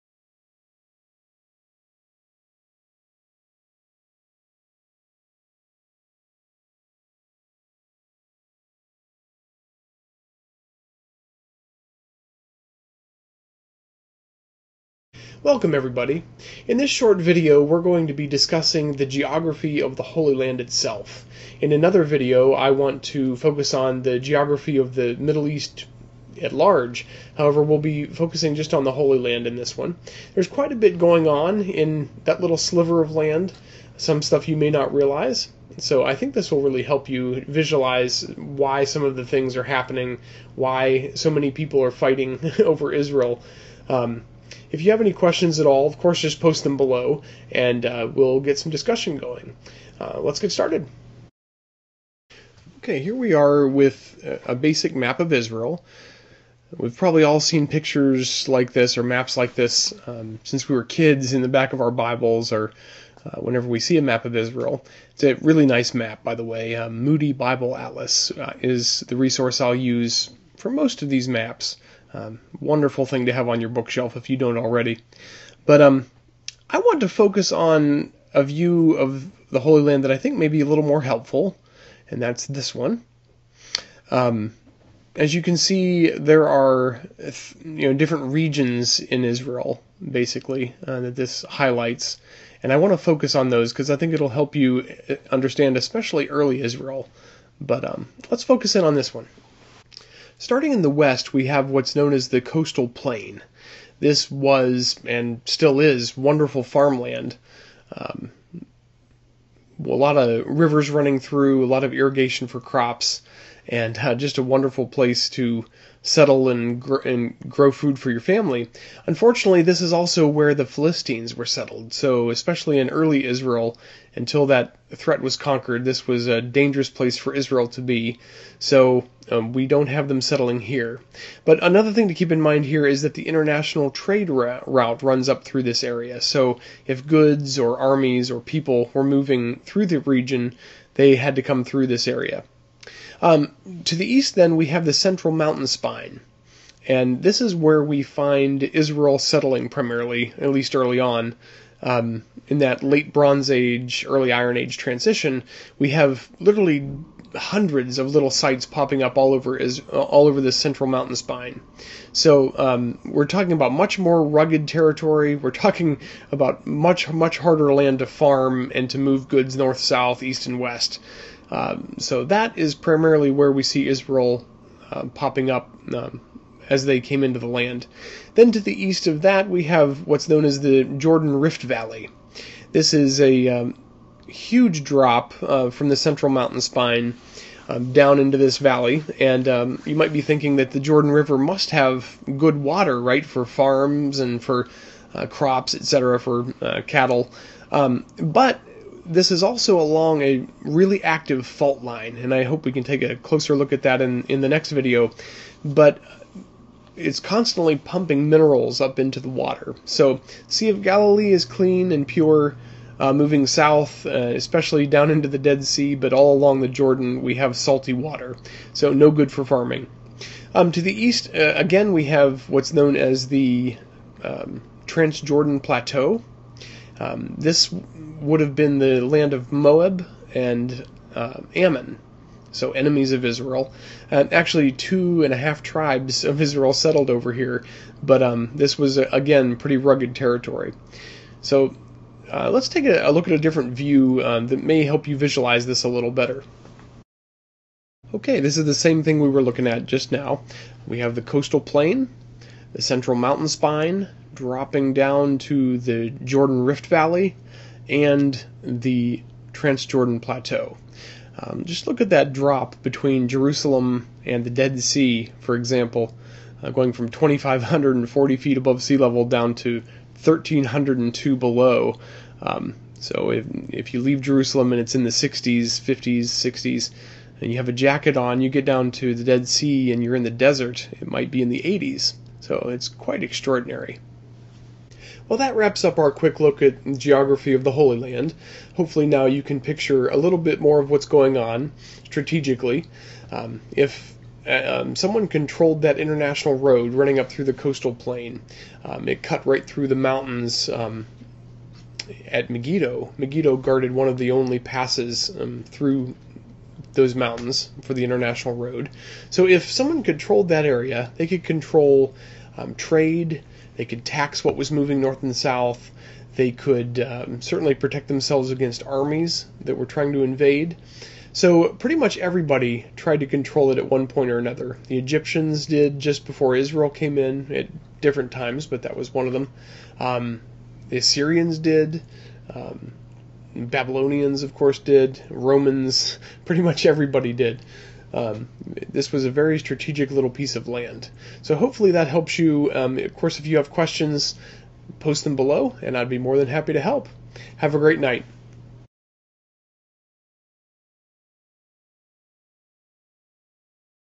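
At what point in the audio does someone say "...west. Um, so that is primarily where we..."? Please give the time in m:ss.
2:50.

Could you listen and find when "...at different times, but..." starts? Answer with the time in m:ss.
5:27.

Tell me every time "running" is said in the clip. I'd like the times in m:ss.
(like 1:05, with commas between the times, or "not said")
1:50, 4:56.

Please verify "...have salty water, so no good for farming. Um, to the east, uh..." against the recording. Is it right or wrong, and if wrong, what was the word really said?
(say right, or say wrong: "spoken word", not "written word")
right.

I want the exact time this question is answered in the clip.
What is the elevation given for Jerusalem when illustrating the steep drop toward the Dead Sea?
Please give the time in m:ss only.
4:27.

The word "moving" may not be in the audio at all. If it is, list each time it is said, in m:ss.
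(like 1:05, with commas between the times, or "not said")
2:19, 3:33, 5:14.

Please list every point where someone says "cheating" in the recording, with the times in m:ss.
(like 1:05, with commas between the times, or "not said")
not said.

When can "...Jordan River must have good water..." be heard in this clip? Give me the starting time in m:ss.
3:10.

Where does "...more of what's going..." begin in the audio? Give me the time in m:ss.
4:50.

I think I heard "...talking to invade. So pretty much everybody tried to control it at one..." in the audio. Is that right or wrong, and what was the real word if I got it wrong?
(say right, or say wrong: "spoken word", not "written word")
wrong: "trying", not "talking".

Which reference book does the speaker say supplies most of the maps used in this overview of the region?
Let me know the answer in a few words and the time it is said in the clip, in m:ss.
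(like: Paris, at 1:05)
Moody Bible Atlas, at 1:07.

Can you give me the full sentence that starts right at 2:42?
So um, we're talking about much more rugged territory.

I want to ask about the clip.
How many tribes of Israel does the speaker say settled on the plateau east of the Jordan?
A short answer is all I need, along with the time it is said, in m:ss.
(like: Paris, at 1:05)
2.5, at 3:54.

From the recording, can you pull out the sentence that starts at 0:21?
In another video I want to focus on the geography of the Middle East at large.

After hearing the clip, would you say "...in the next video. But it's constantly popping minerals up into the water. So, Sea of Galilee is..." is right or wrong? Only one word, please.
wrong.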